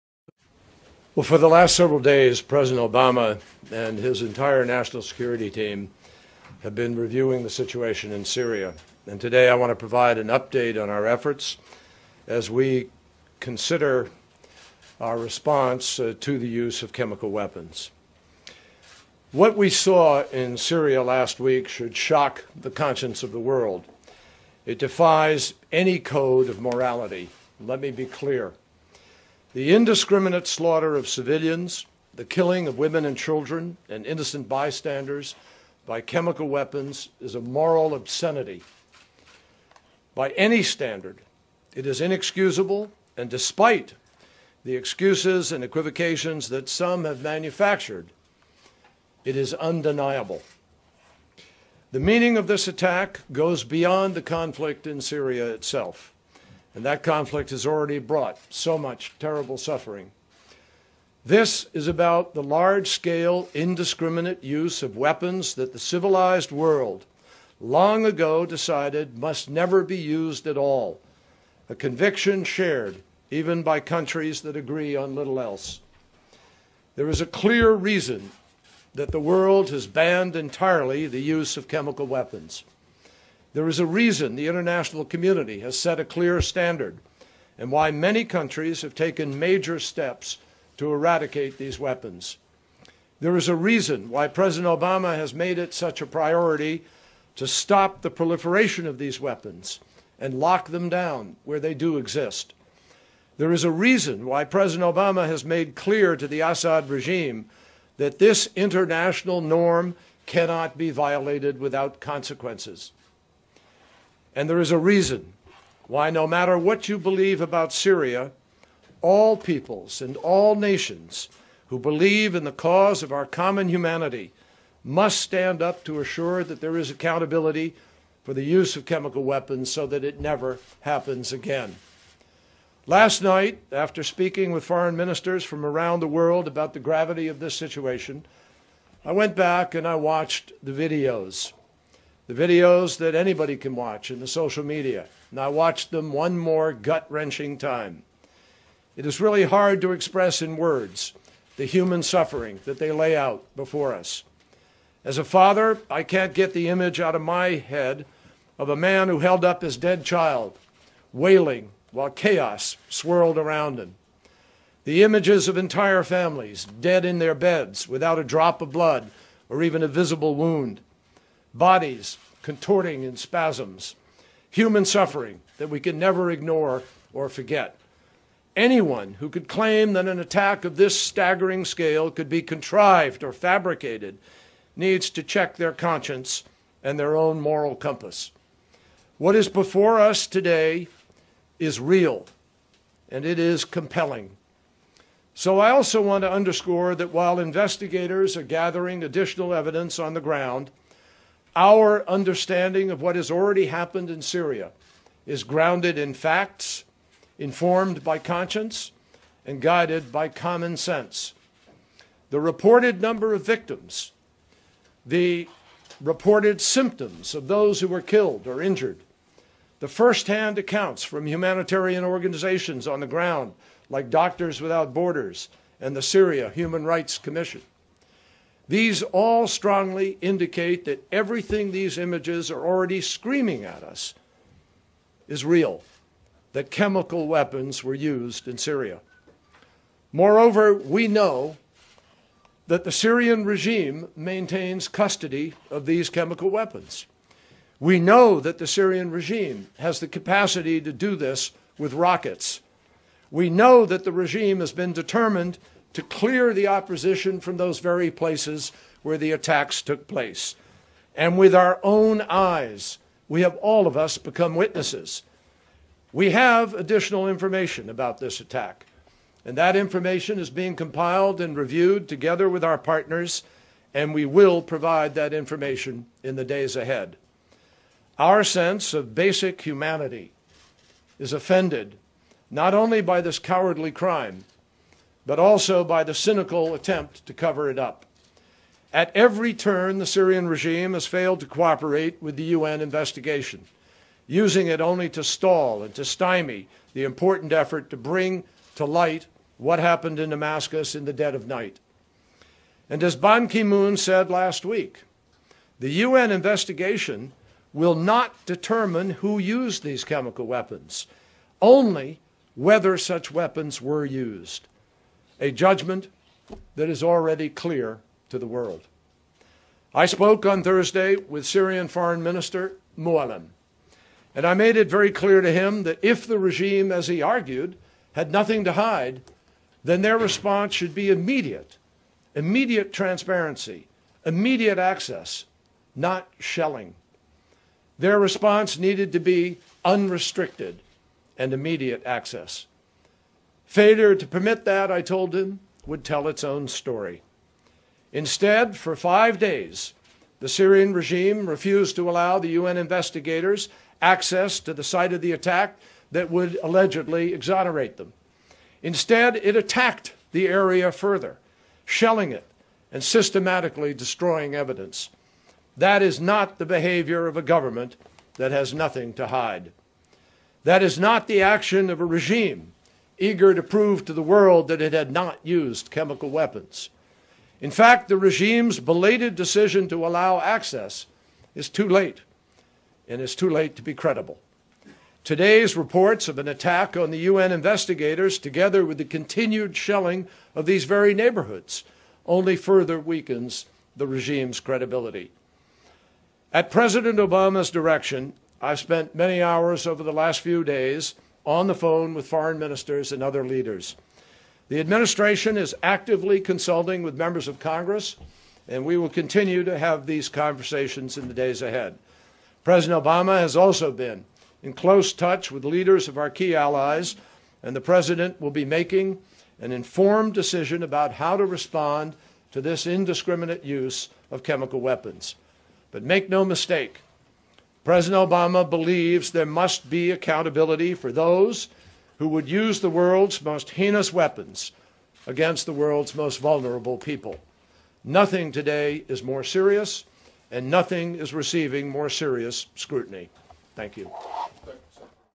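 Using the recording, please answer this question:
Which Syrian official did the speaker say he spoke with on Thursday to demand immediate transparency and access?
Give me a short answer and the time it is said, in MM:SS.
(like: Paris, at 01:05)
Foreign Minister Mualem, at 05:21.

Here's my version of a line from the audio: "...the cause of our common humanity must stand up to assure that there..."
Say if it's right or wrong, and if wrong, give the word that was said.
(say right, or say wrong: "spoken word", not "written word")
right.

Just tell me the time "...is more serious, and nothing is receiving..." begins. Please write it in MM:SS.
07:19.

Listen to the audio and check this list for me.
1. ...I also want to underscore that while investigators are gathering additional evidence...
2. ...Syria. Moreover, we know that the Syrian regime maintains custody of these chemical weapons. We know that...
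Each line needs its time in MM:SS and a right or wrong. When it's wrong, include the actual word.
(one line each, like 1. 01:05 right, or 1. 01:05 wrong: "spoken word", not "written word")
1. 03:15 right
2. 03:58 right.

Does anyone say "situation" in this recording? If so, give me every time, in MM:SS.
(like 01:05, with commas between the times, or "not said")
00:07, 02:17.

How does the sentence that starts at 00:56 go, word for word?
And that conflict has already brought so much terrible suffering.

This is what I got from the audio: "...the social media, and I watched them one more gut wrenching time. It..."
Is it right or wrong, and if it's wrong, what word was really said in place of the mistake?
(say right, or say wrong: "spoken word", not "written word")
right.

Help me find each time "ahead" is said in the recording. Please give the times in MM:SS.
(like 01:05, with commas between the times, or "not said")
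04:36, 06:51.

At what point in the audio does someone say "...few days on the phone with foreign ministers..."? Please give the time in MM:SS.
06:40.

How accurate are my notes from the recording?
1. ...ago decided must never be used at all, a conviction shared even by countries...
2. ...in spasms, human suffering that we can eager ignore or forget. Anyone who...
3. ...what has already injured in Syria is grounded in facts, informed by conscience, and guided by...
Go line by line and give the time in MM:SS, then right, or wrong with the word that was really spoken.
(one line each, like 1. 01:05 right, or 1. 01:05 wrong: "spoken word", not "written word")
1. 01:08 right
2. 02:53 wrong: "never", not "eager"
3. 03:23 wrong: "happened", not "injured".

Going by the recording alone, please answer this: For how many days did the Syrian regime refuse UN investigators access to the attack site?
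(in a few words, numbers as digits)
5.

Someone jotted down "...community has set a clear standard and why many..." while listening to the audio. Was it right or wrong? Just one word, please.
right.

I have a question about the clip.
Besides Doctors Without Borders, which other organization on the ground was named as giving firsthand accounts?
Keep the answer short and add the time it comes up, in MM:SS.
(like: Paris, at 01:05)
Syria Human Rights Commission, at 03:46.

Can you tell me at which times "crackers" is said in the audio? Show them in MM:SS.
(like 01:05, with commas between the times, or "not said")
not said.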